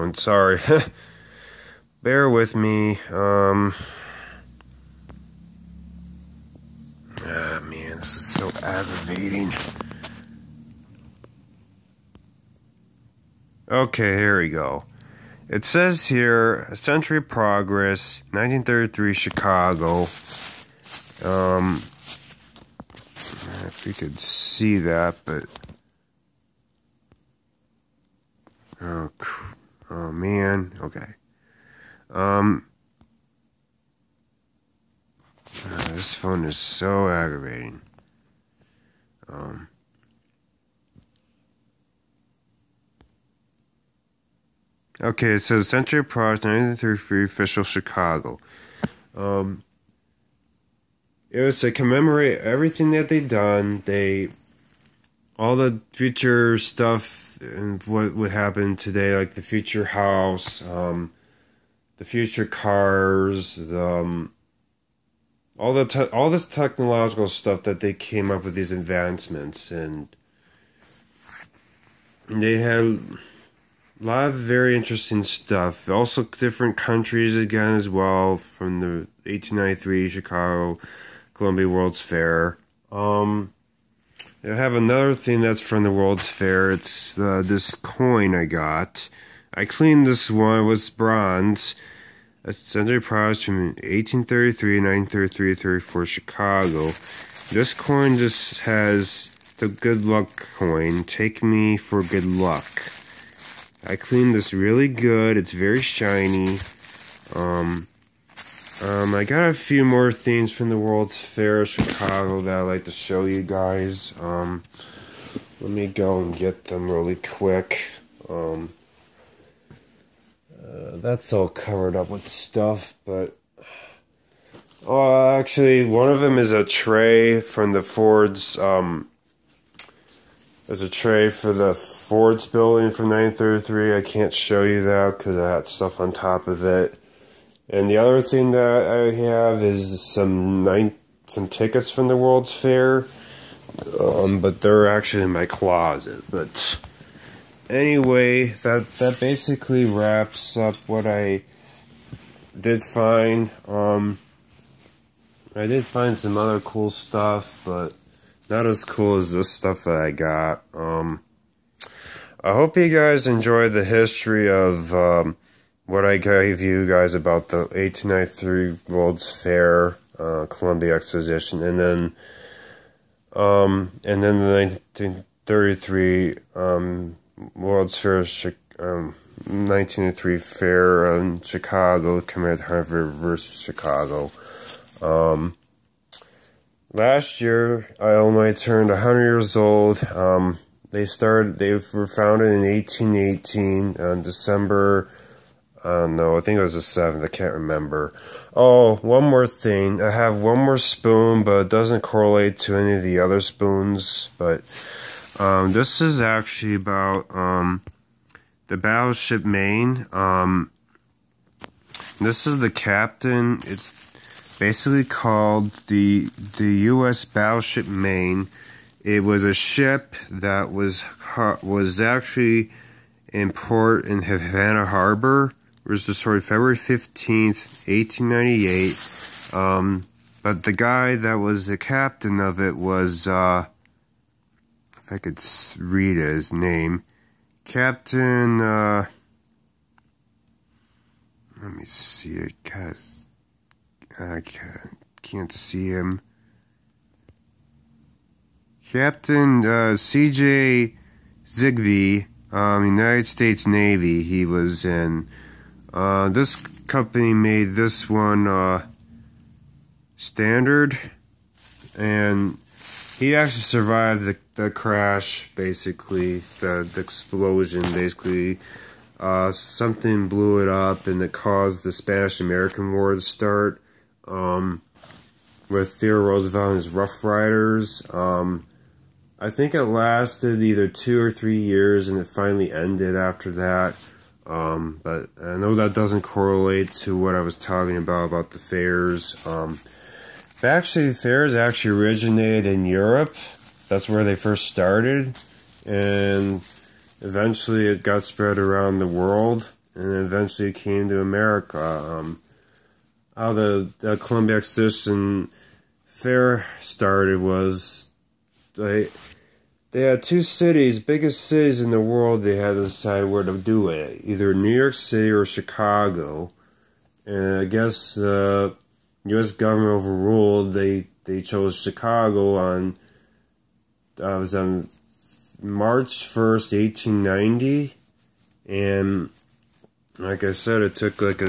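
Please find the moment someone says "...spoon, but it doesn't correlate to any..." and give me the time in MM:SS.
03:20.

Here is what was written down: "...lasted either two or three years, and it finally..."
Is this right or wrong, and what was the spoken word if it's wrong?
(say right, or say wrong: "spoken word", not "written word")
right.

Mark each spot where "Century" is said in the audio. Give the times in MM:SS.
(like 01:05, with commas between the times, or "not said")
00:16, 00:45, 01:32.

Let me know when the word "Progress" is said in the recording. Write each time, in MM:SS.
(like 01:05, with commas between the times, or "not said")
00:17, 00:46.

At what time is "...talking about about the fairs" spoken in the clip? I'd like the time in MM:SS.
04:47.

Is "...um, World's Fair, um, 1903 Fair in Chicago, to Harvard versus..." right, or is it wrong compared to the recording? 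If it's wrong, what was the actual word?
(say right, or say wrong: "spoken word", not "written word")
right.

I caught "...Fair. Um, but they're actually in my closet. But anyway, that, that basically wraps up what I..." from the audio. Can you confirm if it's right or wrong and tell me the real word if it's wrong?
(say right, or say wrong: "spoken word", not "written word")
right.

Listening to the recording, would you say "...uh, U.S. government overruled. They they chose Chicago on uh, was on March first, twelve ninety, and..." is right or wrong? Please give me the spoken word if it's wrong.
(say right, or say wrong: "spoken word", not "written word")
wrong: "eighteen", not "twelve".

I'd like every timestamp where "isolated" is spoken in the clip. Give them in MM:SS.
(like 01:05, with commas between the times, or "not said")
not said.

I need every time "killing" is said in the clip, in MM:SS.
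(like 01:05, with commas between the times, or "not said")
not said.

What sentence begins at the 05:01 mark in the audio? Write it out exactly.
Um, how the, the Columbia Exposition Fair started was they they had two cities, biggest cities in the world.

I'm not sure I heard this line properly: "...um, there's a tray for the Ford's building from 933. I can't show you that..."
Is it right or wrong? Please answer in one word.
right.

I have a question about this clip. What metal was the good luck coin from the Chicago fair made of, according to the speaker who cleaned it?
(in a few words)
bronze.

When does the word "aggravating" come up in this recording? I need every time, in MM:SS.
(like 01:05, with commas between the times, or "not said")
00:08, 00:37.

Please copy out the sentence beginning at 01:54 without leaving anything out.
Um, let me go and get them really quick.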